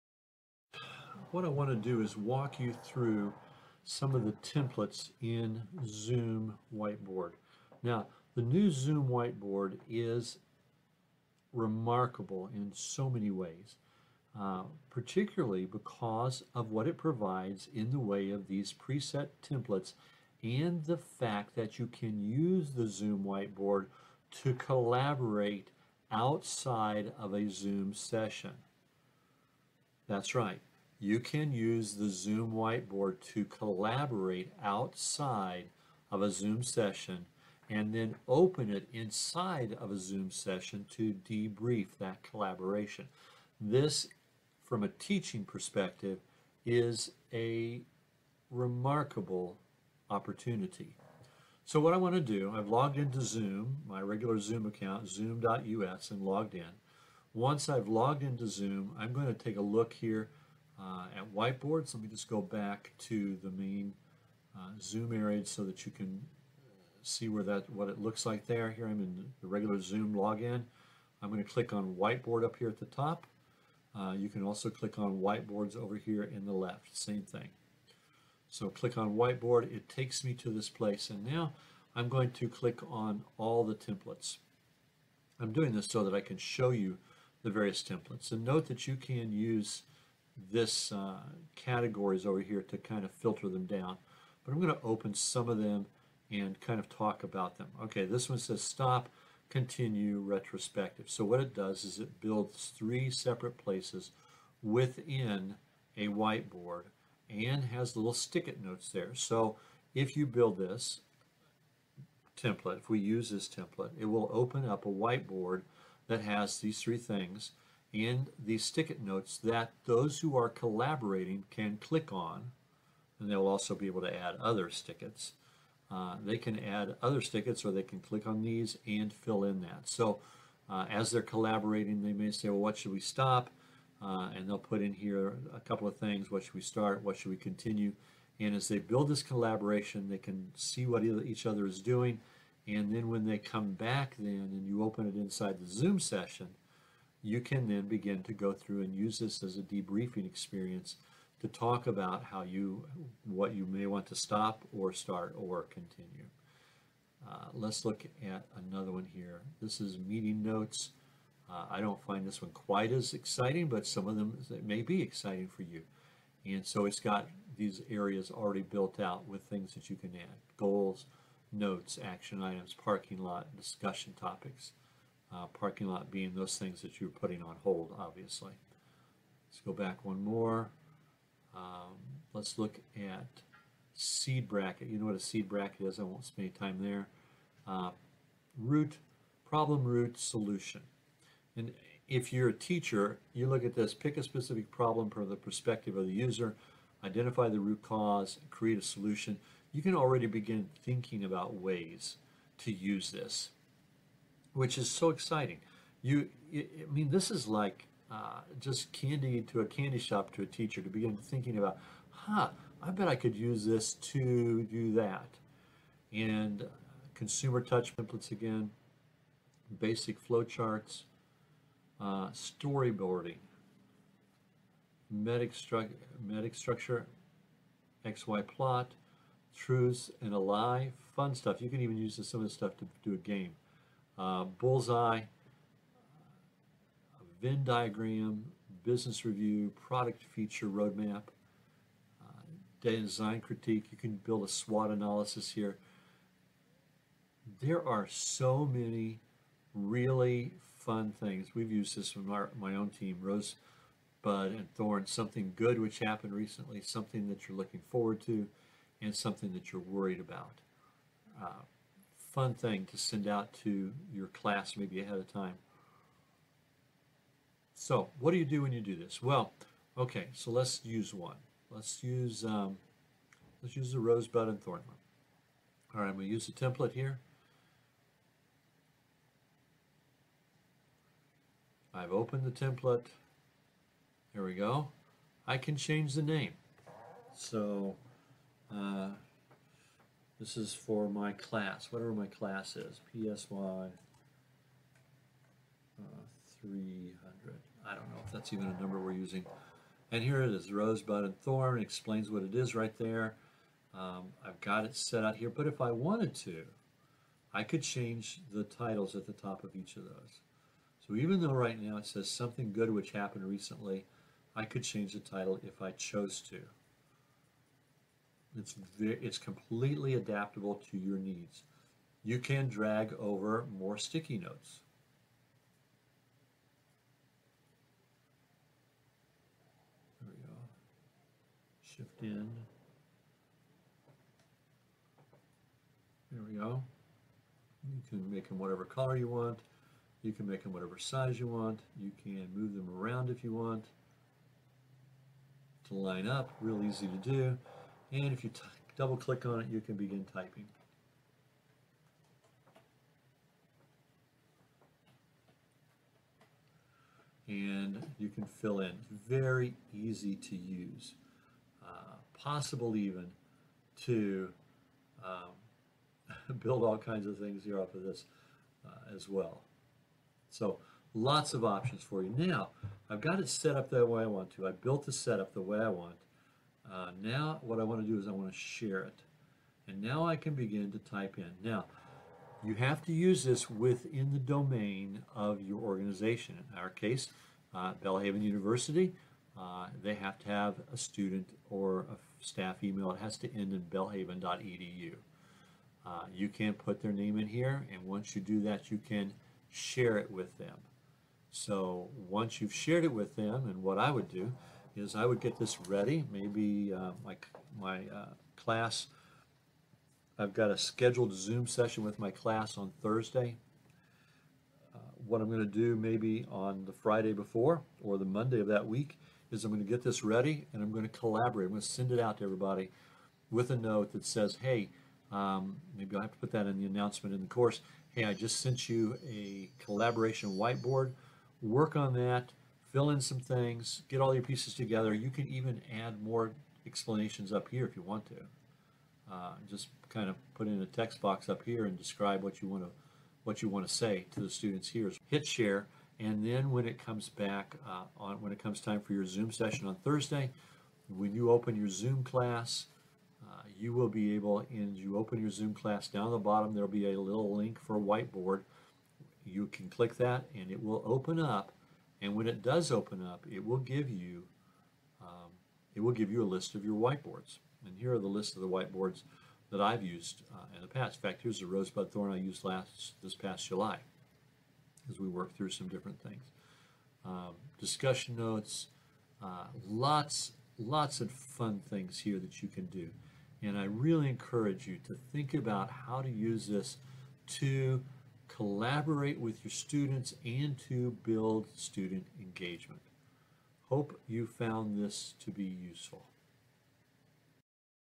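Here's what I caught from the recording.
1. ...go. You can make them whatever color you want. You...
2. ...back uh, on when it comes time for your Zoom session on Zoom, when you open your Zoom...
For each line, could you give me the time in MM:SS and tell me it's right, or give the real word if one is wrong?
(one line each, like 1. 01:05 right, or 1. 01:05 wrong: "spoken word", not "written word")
1. 05:36 right
2. 07:27 wrong: "Thursday", not "Zoom".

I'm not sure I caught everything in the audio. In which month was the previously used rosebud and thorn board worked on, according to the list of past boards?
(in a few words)
July.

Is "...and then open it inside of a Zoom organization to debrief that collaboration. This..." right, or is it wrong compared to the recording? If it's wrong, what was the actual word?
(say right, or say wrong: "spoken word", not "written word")
wrong: "session", not "organization".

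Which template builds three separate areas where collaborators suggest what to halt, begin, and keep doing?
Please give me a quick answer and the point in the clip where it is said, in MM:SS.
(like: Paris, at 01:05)
Stop, continue, retrospective, at 01:38.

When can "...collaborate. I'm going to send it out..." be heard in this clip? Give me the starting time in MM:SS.
07:01.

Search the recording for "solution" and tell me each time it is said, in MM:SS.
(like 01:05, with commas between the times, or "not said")
03:10, 03:18.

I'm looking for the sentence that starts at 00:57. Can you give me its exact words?
Once I've logged into Zoom, I'm going to take a look here uh, at whiteboards.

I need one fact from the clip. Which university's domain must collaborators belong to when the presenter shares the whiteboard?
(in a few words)
Belhaven University.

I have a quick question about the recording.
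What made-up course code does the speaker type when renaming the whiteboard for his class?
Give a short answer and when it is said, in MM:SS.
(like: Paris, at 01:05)
PSY 300, at 04:53.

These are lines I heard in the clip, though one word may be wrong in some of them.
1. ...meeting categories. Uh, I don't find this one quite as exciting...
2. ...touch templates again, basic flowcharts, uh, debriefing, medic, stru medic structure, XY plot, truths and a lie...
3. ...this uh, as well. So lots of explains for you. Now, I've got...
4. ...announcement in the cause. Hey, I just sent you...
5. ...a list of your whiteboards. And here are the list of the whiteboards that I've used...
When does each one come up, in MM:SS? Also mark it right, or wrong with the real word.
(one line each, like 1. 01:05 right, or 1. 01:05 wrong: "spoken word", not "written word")
1. 02:39 wrong: "notes", not "categories"
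2. 03:37 wrong: "storyboarding", not "debriefing"
3. 06:08 wrong: "options", not "explains"
4. 07:06 wrong: "course", not "cause"
5. 07:46 right.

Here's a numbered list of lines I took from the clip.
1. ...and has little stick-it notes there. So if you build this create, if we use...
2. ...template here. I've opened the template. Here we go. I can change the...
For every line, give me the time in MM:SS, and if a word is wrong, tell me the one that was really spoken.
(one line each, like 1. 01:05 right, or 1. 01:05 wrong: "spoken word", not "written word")
1. 01:47 wrong: "template", not "create"
2. 04:36 right.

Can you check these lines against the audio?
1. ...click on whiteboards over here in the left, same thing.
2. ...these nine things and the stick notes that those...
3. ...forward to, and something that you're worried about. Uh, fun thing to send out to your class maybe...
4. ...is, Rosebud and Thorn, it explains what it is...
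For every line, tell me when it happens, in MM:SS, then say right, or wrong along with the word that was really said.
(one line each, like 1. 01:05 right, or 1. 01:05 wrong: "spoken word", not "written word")
1. 01:14 right
2. 01:56 wrong: "three", not "nine"
3. 04:17 right
4. 05:00 right.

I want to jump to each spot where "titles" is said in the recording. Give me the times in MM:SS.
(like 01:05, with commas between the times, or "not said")
05:08, 05:15.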